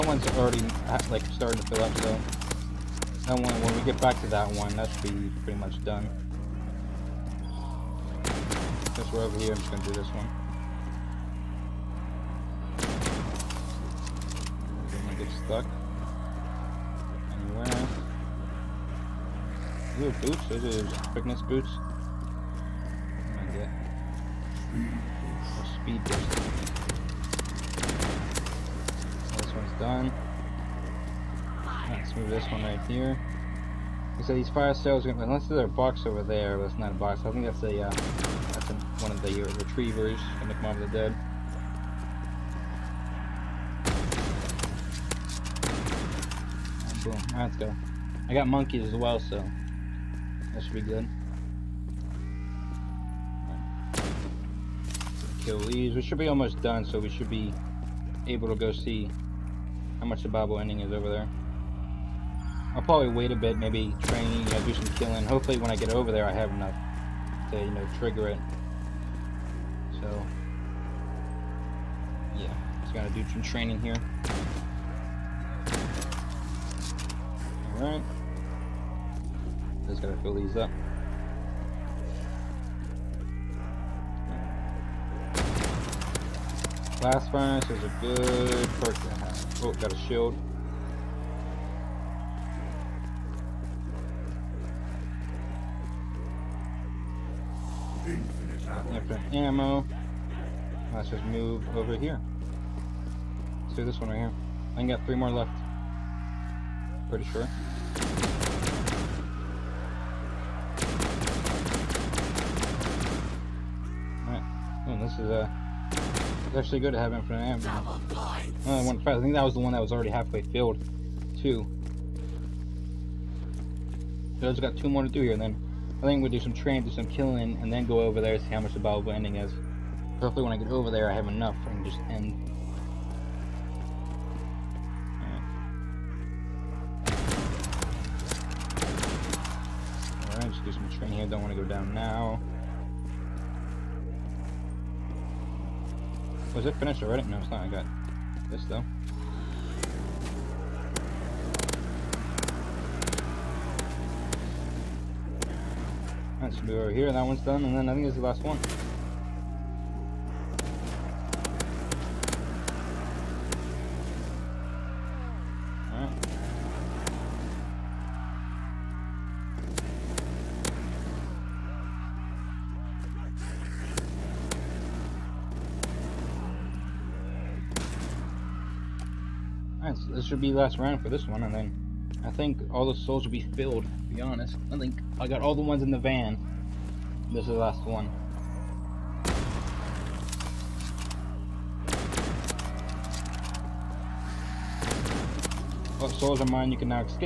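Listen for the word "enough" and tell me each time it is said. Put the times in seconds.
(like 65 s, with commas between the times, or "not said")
66 s, 131 s.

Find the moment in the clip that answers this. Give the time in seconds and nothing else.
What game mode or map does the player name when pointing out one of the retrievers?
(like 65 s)
40 s.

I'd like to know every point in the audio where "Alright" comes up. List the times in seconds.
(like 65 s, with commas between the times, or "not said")
47 s, 77 s, 114 s, 140 s, 165 s.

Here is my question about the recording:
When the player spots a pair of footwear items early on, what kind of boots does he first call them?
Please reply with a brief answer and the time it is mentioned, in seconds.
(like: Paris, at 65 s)
Quickness boots, at 21 s.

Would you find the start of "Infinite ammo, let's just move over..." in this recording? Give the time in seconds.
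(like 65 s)
98 s.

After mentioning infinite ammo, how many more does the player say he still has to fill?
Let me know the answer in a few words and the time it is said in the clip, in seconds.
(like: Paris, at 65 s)
3, at 105 s.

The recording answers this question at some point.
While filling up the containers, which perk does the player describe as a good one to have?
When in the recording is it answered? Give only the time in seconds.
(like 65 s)
87 s.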